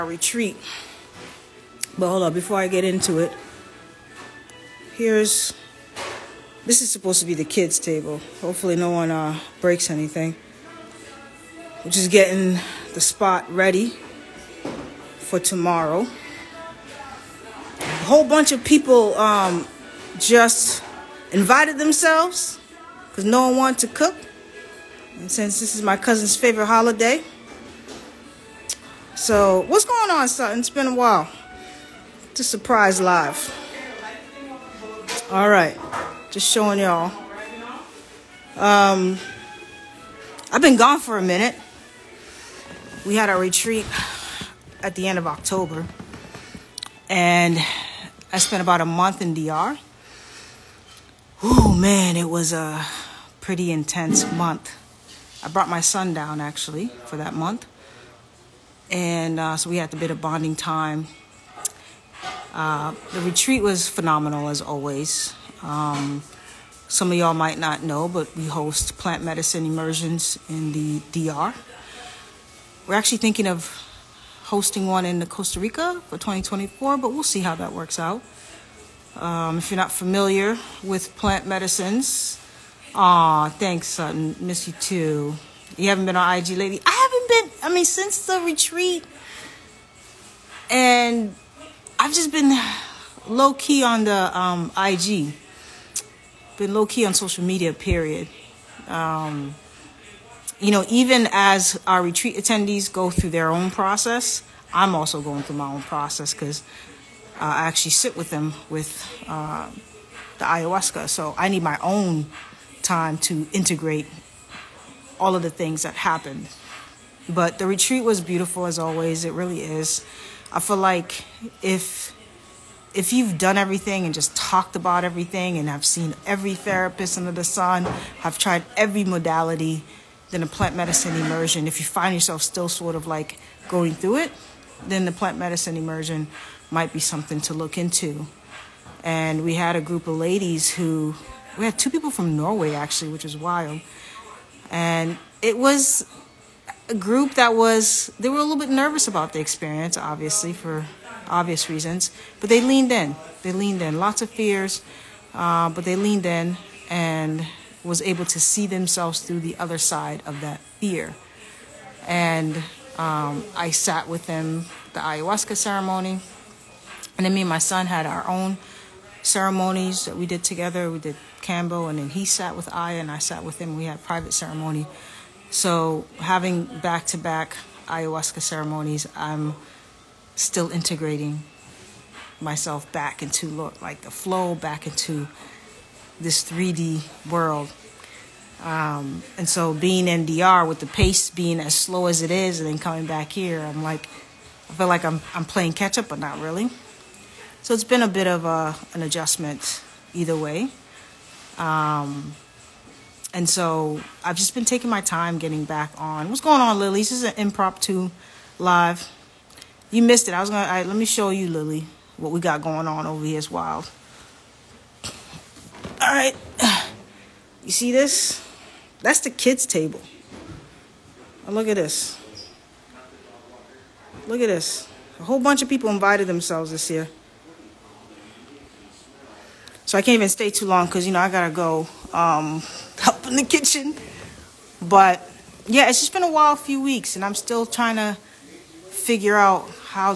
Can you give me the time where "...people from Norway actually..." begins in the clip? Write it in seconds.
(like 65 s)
141 s.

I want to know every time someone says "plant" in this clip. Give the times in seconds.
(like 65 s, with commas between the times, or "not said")
68 s, 81 s, 130 s, 135 s.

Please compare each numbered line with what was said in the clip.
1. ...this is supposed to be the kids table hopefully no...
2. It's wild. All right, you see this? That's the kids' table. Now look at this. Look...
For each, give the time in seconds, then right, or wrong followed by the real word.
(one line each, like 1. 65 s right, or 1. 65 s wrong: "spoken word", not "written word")
1. 6 s right
2. 213 s right.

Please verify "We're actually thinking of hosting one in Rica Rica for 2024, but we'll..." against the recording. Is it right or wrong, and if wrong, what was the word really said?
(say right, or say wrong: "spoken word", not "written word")
wrong: "Costa", not "Rica".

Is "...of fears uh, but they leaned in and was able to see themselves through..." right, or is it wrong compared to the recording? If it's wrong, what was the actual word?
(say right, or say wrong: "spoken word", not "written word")
right.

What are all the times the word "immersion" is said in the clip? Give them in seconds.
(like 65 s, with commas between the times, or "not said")
69 s, 131 s, 135 s.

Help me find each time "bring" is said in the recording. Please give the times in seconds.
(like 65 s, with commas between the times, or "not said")
not said.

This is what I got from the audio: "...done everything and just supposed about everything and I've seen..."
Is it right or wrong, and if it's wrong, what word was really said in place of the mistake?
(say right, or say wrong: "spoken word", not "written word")
wrong: "talked", not "supposed".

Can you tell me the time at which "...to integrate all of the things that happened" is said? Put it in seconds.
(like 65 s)
113 s.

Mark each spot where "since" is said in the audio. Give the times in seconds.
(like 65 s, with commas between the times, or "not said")
25 s, 87 s.